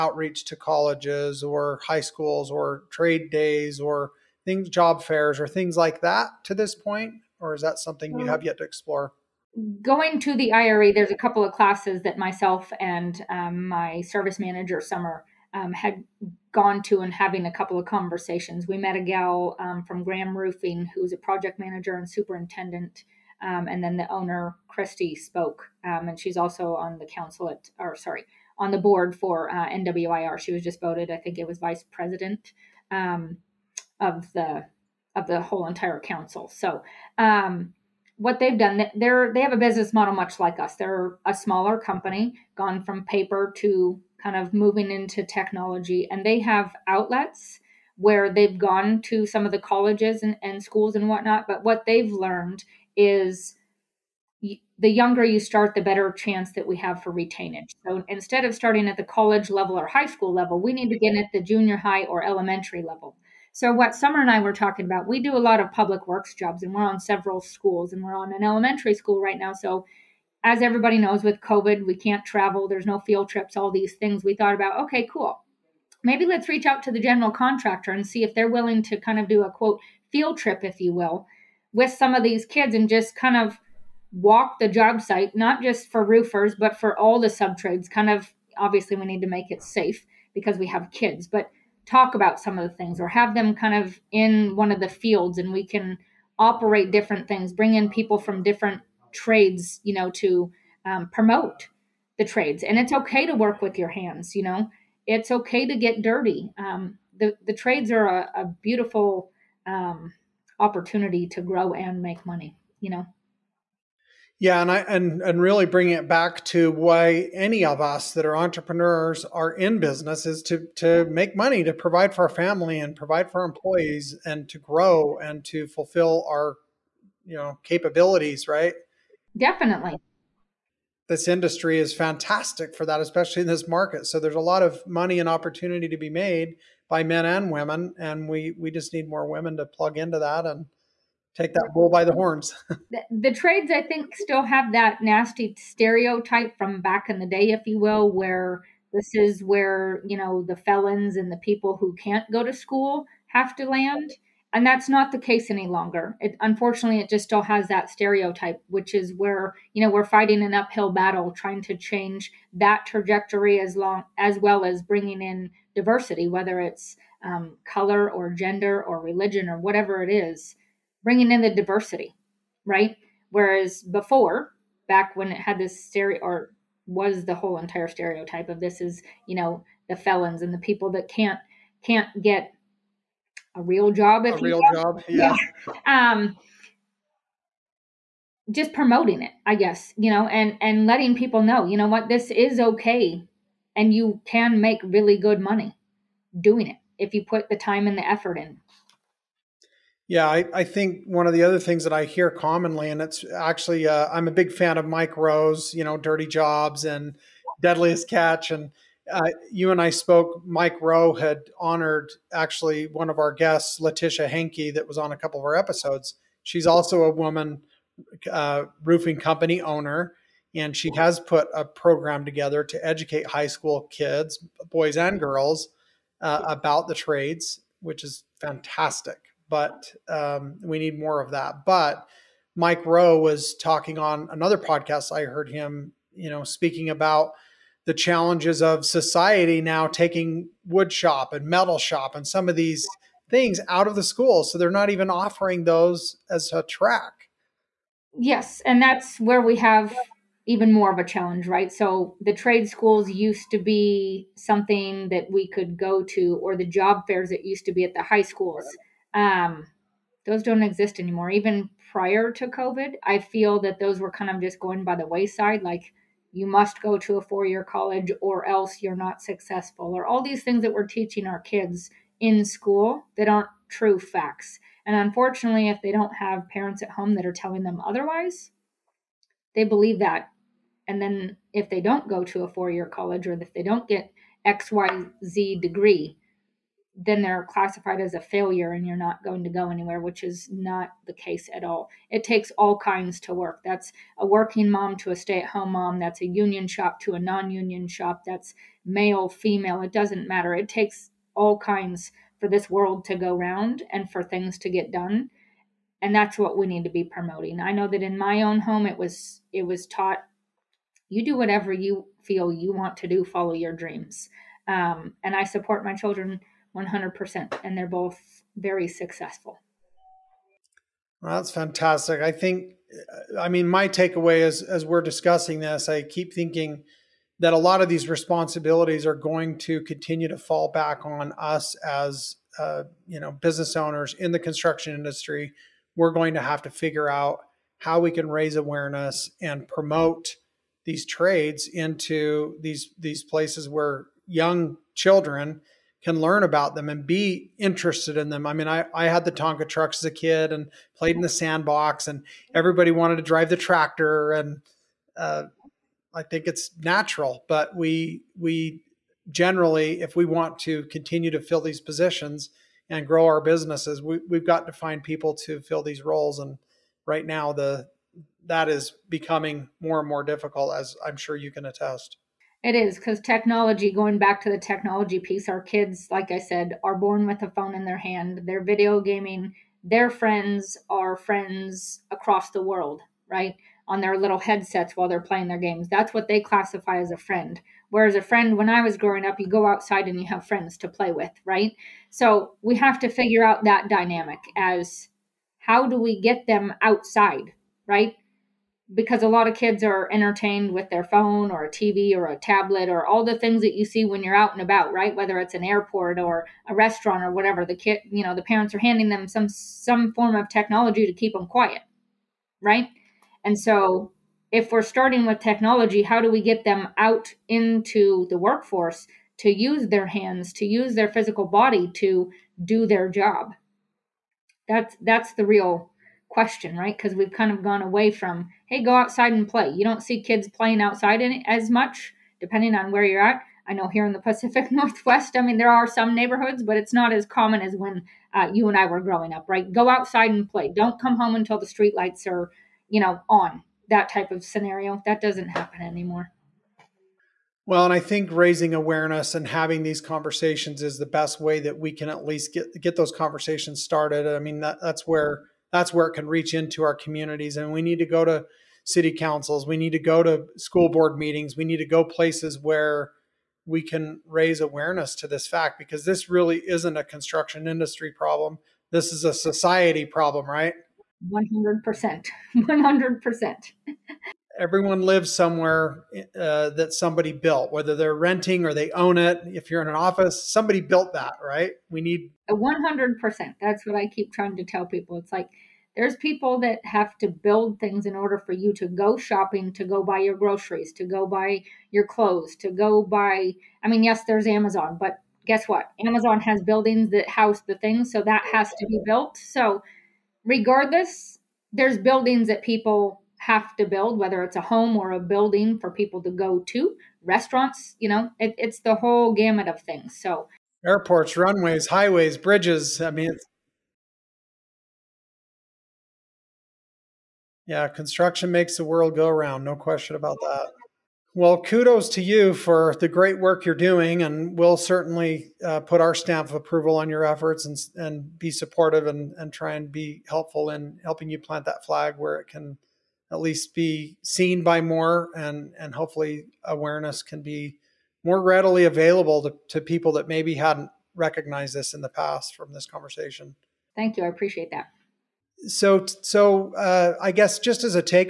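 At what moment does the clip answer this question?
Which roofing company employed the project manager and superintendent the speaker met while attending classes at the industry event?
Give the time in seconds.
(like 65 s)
20 s.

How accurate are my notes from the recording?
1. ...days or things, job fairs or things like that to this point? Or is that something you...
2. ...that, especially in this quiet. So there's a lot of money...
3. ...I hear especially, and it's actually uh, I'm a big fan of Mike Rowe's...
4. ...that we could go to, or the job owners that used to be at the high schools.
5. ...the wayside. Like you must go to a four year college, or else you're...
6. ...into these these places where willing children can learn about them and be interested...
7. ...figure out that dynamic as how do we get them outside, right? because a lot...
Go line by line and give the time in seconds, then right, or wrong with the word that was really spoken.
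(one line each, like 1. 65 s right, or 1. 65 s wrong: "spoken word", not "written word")
1. 3 s right
2. 132 s wrong: "market", not "quiet"
3. 201 s wrong: "commonly", not "especially"
4. 255 s wrong: "fairs", not "owners"
5. 264 s right
6. 341 s wrong: "young", not "willing"
7. 393 s right.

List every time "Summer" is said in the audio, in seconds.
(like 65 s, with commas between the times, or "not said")
14 s, 63 s.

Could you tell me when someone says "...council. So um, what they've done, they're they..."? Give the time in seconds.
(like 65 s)
35 s.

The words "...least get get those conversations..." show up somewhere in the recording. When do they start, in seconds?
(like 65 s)
452 s.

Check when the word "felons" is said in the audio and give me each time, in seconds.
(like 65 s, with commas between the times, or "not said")
150 s, 179 s.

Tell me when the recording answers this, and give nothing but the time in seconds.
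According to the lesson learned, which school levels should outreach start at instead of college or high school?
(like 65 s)
61 s.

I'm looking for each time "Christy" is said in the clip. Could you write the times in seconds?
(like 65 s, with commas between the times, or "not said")
24 s.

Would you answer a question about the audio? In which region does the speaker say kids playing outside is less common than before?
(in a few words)
Pacific Northwest.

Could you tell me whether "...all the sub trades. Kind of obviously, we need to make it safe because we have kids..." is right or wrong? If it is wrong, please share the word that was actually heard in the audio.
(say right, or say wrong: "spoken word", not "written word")
right.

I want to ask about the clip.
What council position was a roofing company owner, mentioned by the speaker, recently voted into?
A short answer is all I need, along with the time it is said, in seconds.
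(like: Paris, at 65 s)
vice president, at 31 s.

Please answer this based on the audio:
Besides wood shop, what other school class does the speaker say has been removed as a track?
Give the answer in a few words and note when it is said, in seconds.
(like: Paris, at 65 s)
metal shop, at 241 s.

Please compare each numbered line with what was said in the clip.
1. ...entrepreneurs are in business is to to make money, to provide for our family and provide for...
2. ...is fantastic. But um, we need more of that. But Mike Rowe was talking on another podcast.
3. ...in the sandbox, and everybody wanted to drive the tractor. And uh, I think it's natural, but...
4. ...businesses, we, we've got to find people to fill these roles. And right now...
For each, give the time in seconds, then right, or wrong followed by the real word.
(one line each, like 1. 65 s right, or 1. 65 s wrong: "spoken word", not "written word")
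1. 118 s right
2. 228 s right
3. 351 s right
4. 363 s right.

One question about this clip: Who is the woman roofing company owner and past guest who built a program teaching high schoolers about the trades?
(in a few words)
Letitia Henke.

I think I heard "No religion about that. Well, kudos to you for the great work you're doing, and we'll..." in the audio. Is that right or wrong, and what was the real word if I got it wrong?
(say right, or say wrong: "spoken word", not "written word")
wrong: "question", not "religion".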